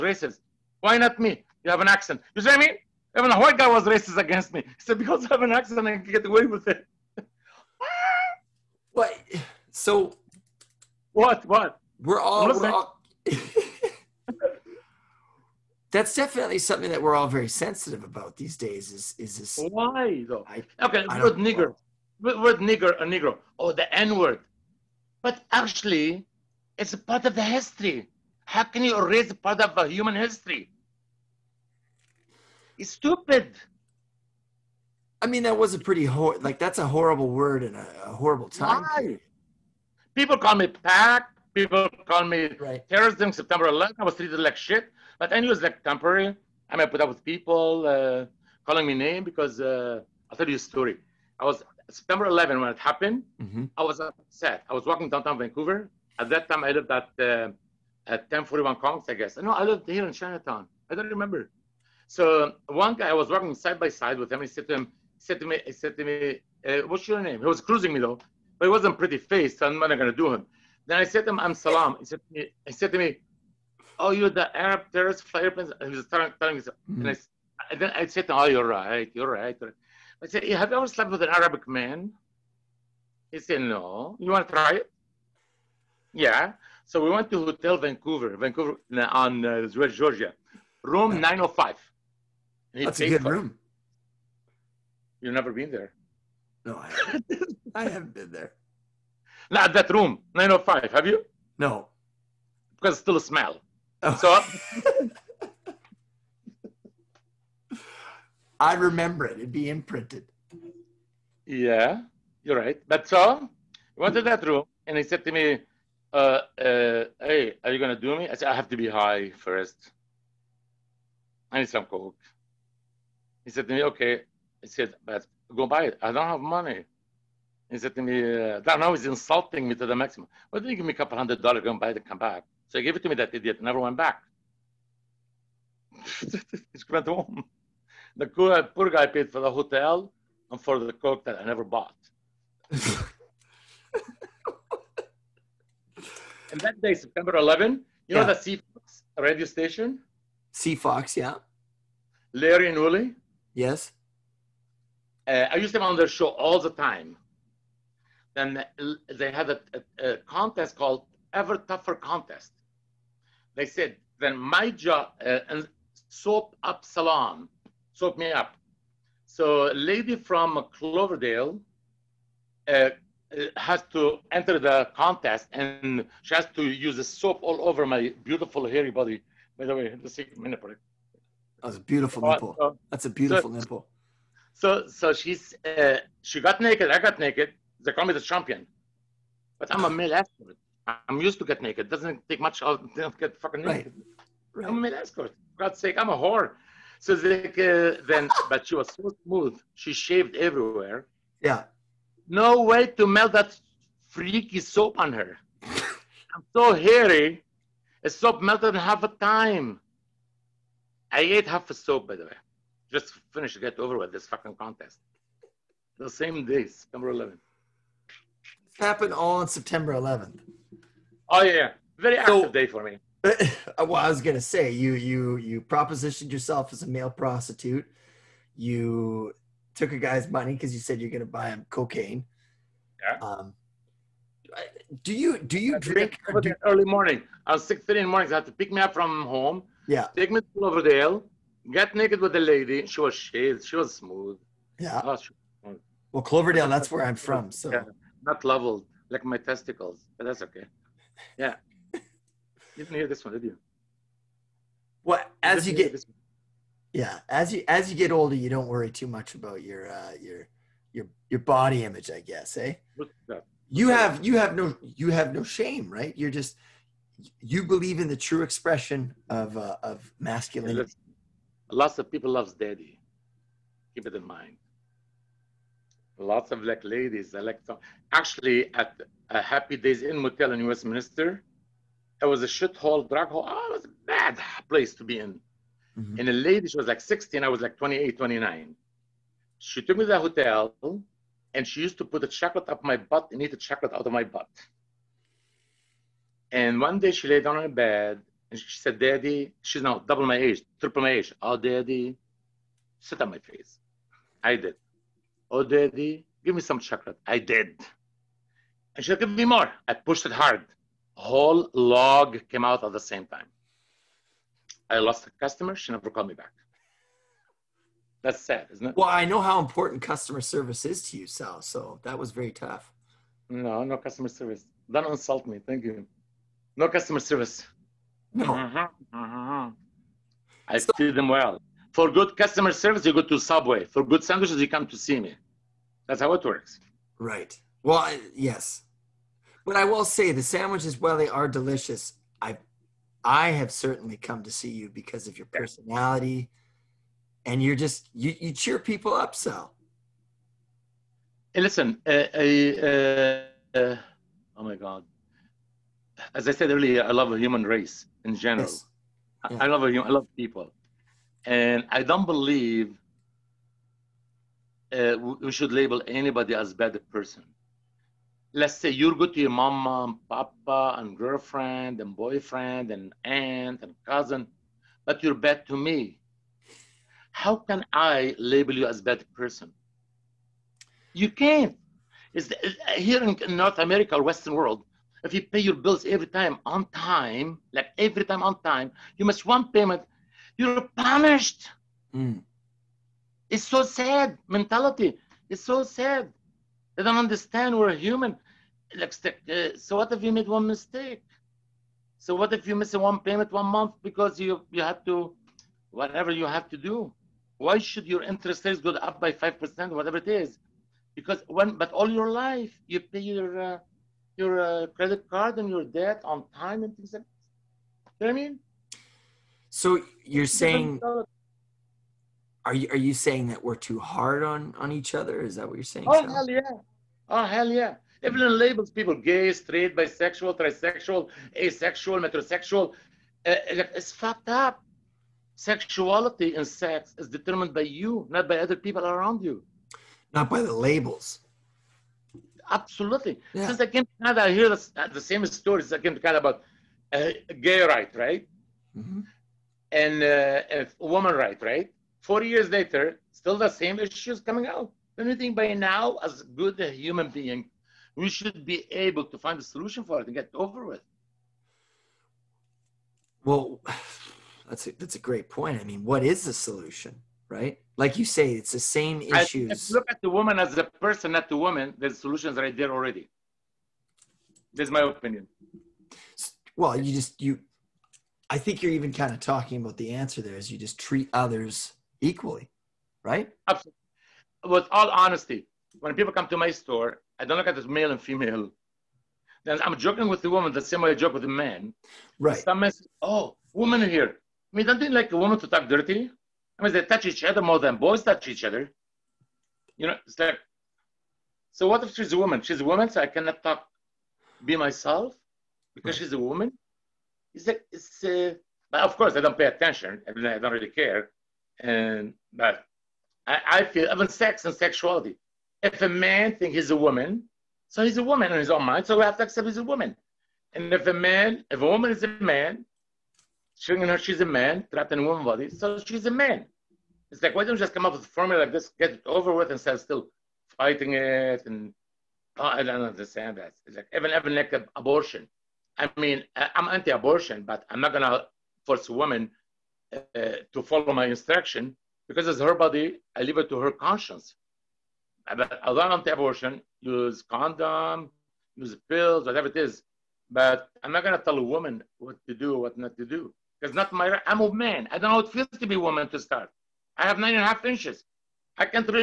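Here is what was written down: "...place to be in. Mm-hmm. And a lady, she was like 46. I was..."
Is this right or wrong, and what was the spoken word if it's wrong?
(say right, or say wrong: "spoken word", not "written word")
wrong: "16", not "46".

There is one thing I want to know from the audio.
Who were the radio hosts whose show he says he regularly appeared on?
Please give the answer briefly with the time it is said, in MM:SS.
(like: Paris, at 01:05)
Larry and Willie, at 02:32.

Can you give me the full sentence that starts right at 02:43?
They said, then my job, uh, and soap up salon, soap me up.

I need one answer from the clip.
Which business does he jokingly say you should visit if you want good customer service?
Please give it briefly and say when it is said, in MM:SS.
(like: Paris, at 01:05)
Subway, at 05:33.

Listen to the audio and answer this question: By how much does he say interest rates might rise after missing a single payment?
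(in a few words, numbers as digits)
5%.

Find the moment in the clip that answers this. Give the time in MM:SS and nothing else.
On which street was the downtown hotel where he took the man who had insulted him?
01:29.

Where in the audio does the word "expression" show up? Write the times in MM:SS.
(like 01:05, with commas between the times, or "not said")
04:28.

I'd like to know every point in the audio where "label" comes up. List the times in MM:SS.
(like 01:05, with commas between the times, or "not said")
06:05, 06:18, 07:08, 07:20.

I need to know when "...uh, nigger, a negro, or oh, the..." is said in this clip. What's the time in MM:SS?
00:22.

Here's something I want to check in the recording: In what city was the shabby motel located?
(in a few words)
Westminster.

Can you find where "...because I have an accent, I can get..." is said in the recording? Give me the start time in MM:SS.
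00:04.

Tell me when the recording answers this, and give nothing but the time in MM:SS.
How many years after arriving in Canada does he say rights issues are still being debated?
07:32.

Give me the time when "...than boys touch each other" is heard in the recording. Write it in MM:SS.
08:17.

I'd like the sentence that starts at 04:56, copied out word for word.
And one day she lay down on her bed and she said, Daddy, she's now double my age, triple my age.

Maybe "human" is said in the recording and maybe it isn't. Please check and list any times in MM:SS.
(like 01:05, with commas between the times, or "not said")
00:29, 05:57, 06:37, 07:36.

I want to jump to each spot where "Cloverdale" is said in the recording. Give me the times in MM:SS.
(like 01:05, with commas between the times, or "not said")
02:50, 04:06.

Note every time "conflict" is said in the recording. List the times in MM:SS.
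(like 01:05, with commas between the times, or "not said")
not said.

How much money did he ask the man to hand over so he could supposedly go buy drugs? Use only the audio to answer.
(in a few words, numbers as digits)
A couple hundred dollars.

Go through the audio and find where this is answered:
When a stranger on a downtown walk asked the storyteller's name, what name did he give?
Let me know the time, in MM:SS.
01:11.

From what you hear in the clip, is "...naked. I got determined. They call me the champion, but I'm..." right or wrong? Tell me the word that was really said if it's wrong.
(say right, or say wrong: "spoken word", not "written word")
wrong: "naked", not "determined".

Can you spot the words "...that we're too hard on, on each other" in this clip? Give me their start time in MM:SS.
07:03.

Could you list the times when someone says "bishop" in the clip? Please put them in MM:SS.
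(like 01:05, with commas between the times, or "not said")
not said.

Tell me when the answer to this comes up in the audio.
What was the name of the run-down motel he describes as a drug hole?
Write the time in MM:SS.
04:39.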